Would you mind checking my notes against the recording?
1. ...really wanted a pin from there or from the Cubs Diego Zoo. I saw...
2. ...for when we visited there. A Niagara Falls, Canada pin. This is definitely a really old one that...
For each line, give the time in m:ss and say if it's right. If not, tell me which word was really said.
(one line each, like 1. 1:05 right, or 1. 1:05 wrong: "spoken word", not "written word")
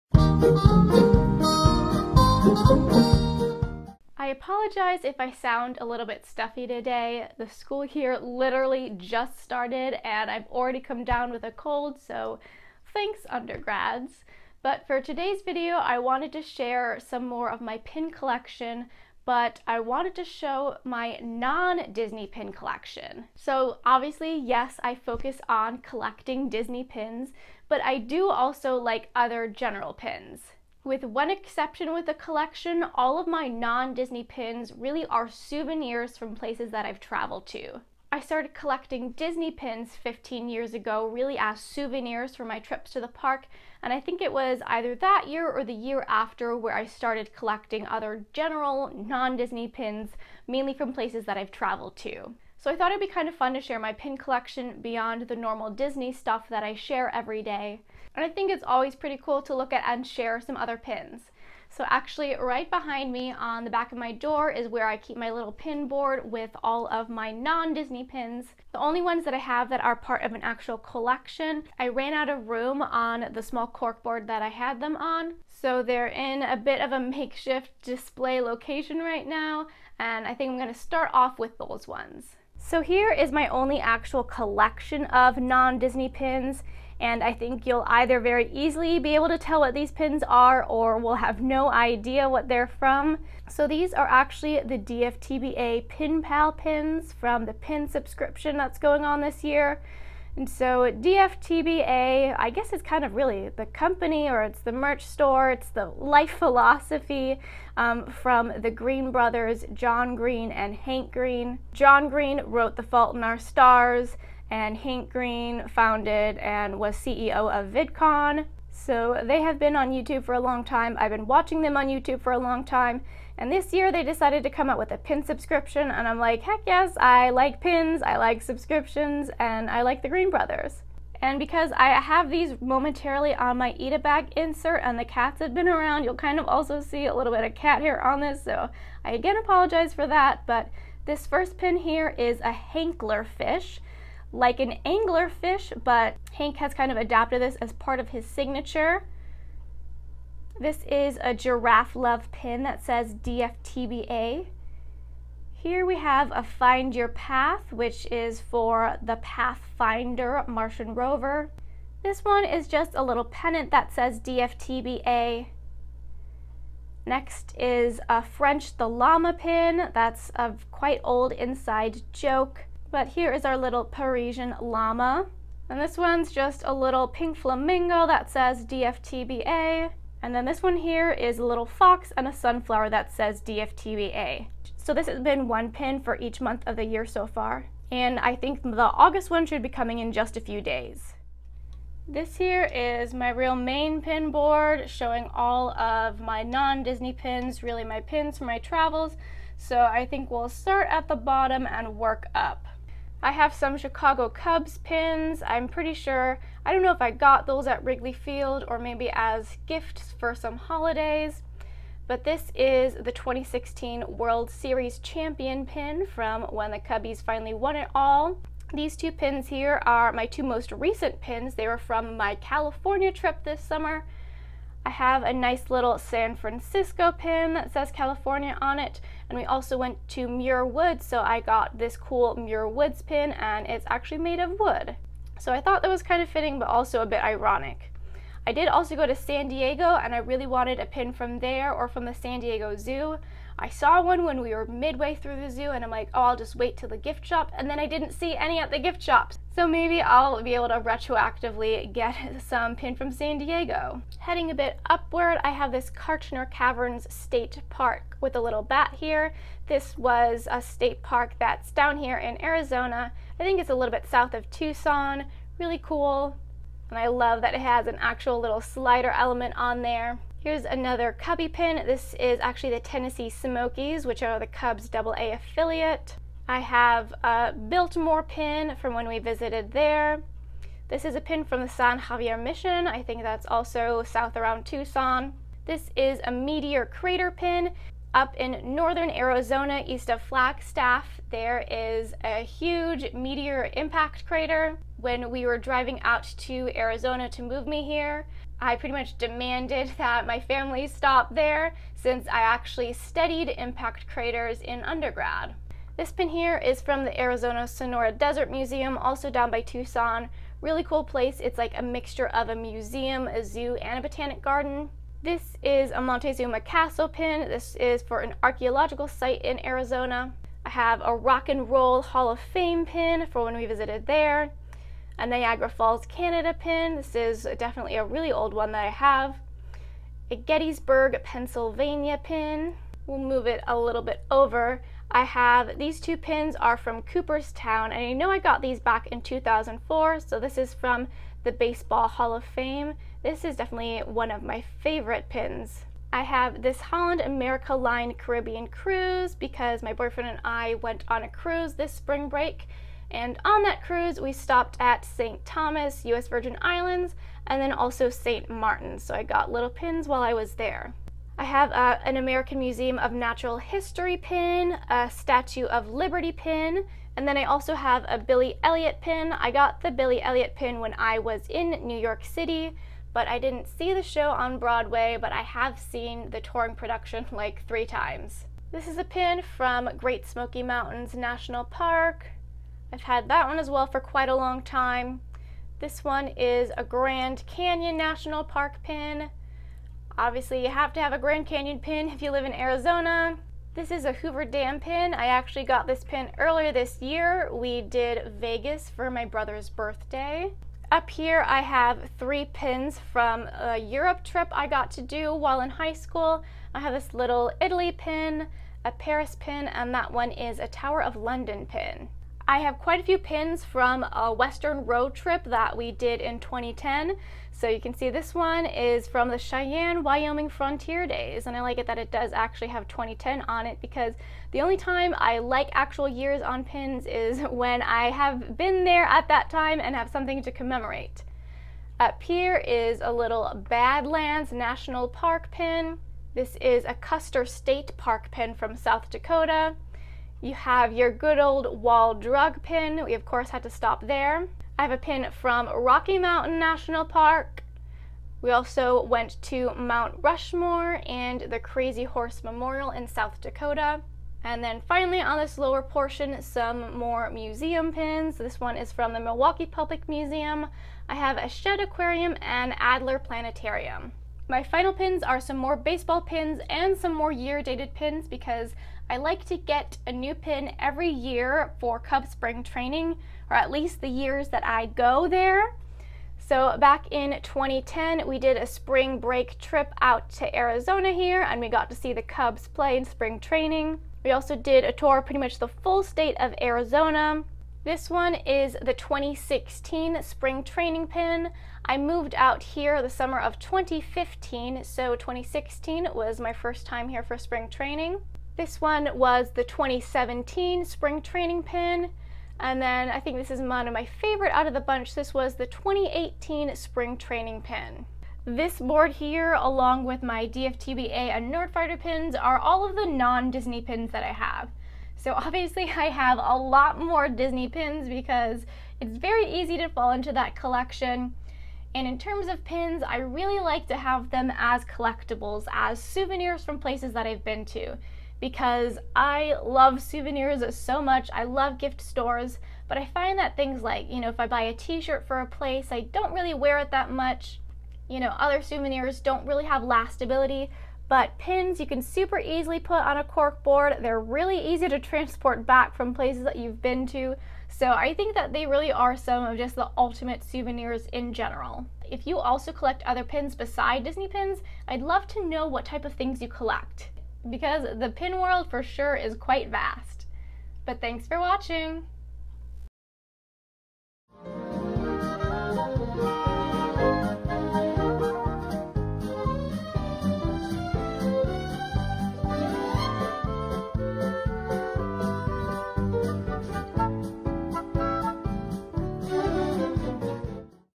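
1. 4:00 wrong: "San", not "Cubs"
2. 5:23 right.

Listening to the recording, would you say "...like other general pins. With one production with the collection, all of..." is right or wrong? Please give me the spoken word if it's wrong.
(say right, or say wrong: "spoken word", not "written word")
wrong: "exception", not "production".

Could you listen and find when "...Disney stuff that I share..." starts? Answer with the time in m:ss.
0:55.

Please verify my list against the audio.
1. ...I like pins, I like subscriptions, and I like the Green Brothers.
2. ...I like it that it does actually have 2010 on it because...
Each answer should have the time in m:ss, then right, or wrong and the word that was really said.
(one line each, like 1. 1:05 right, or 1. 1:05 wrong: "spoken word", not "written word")
1. 2:06 right
2. 7:01 right.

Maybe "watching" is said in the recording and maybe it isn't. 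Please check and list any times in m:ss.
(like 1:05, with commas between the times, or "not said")
2:01, 9:21.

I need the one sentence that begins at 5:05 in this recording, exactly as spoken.
This pin here is from the Arizona Sonora Desert Museum, also down by Tucson.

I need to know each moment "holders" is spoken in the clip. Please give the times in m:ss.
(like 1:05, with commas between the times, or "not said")
not said.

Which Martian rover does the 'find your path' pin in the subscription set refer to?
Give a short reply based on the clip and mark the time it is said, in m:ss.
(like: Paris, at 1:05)
Pathfinder, at 2:39.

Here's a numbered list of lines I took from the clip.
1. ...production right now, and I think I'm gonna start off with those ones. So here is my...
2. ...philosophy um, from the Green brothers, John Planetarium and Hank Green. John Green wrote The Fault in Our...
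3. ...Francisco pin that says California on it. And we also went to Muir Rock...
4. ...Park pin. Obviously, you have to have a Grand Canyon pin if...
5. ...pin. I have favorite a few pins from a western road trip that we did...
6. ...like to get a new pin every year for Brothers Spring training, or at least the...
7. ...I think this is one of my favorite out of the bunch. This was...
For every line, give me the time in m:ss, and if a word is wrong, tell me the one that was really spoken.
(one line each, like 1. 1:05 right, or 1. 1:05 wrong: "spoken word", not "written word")
1. 1:18 wrong: "location", not "production"
2. 1:46 wrong: "Green", not "Planetarium"
3. 3:46 wrong: "Woods", not "Rock"
4. 6:28 right
5. 6:51 wrong: "quite", not "favorite"
6. 7:49 wrong: "Cub", not "Brothers"
7. 8:23 right.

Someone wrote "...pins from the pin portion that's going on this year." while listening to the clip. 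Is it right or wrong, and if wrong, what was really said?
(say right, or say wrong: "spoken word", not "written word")
wrong: "subscription", not "portion".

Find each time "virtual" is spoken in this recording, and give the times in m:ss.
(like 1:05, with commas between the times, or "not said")
not said.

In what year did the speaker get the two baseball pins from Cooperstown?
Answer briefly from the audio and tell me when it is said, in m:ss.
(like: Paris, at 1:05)
2004, at 5:39.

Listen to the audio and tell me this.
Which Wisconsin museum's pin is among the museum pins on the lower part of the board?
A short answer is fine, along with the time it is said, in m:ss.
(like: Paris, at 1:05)
Milwaukee Public Museum, at 7:39.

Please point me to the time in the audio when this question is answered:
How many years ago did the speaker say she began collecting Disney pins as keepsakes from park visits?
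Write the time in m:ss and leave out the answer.
0:40.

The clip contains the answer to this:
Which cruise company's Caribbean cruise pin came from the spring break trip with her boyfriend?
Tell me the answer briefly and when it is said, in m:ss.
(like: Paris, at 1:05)
Holland America Line, at 5:46.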